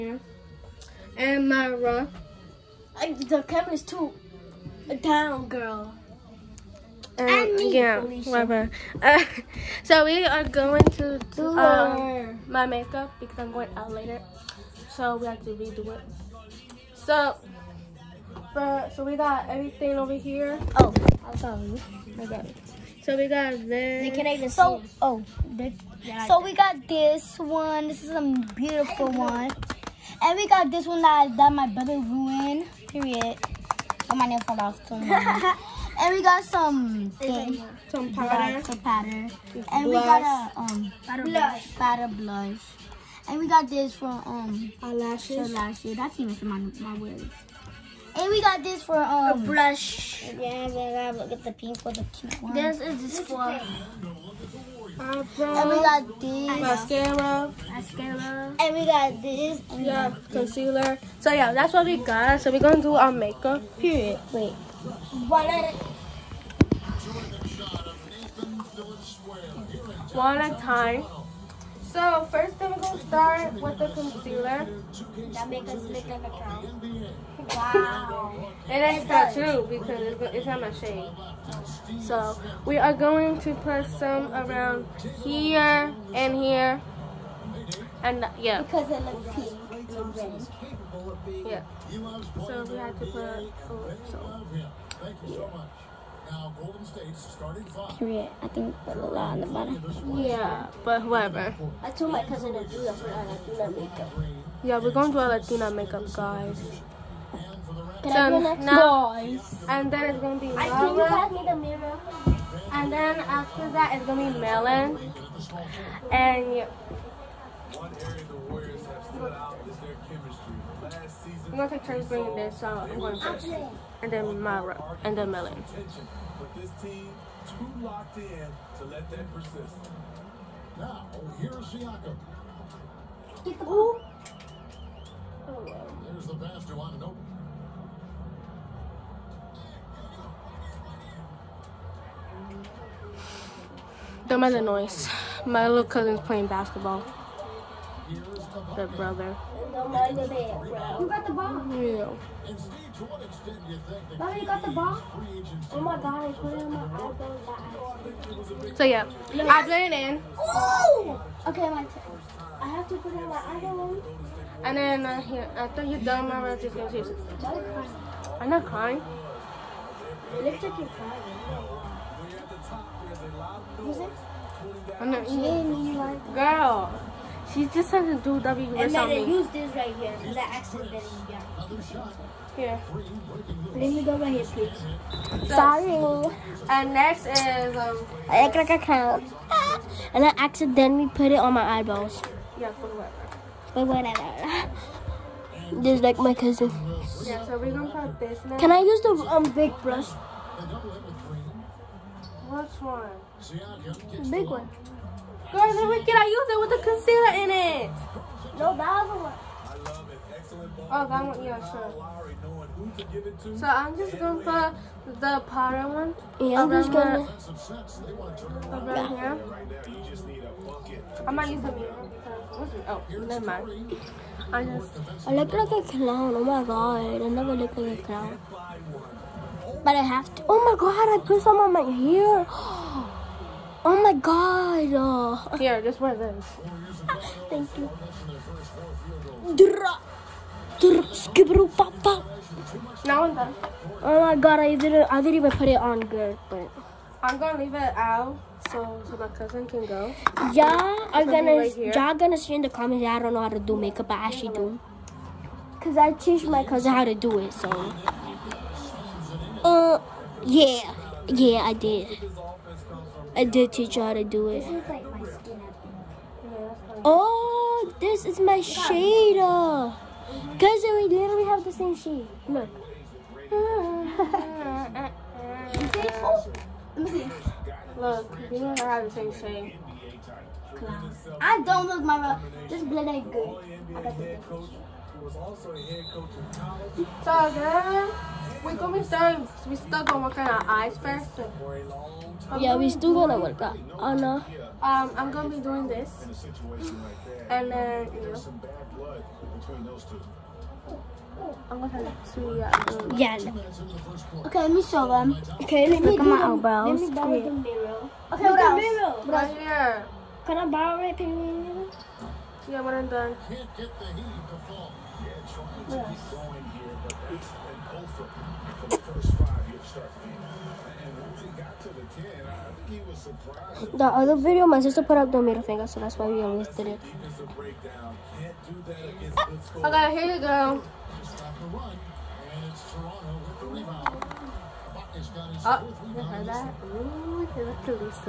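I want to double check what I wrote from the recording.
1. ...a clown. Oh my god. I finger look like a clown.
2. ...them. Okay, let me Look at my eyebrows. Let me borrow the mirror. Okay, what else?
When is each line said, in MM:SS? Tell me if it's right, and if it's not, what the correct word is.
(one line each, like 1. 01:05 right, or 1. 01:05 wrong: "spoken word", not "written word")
1. 03:45 wrong: "never", not "finger"
2. 05:05 right.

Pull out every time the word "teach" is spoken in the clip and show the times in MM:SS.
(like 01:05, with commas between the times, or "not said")
04:16, 04:23.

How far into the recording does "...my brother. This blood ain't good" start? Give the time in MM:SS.
04:42.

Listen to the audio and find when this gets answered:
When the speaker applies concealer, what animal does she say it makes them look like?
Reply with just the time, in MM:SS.
01:16.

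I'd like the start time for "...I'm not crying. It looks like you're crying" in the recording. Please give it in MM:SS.
02:48.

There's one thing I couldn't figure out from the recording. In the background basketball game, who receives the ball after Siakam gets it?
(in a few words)
Anunoby.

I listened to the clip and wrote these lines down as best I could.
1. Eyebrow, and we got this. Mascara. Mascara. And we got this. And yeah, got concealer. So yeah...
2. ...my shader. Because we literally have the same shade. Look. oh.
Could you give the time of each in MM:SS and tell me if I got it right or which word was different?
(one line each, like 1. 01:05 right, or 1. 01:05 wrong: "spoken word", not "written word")
1. 00:54 right
2. 04:28 right.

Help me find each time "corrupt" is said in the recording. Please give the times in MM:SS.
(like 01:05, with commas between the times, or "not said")
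not said.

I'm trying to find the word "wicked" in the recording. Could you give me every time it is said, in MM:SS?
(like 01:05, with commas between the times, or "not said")
03:25.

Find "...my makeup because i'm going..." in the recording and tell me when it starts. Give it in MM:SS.
00:12.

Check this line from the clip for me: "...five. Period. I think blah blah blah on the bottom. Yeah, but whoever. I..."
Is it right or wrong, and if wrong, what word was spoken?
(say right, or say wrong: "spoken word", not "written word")
right.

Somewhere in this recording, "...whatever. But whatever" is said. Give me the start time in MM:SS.
03:12.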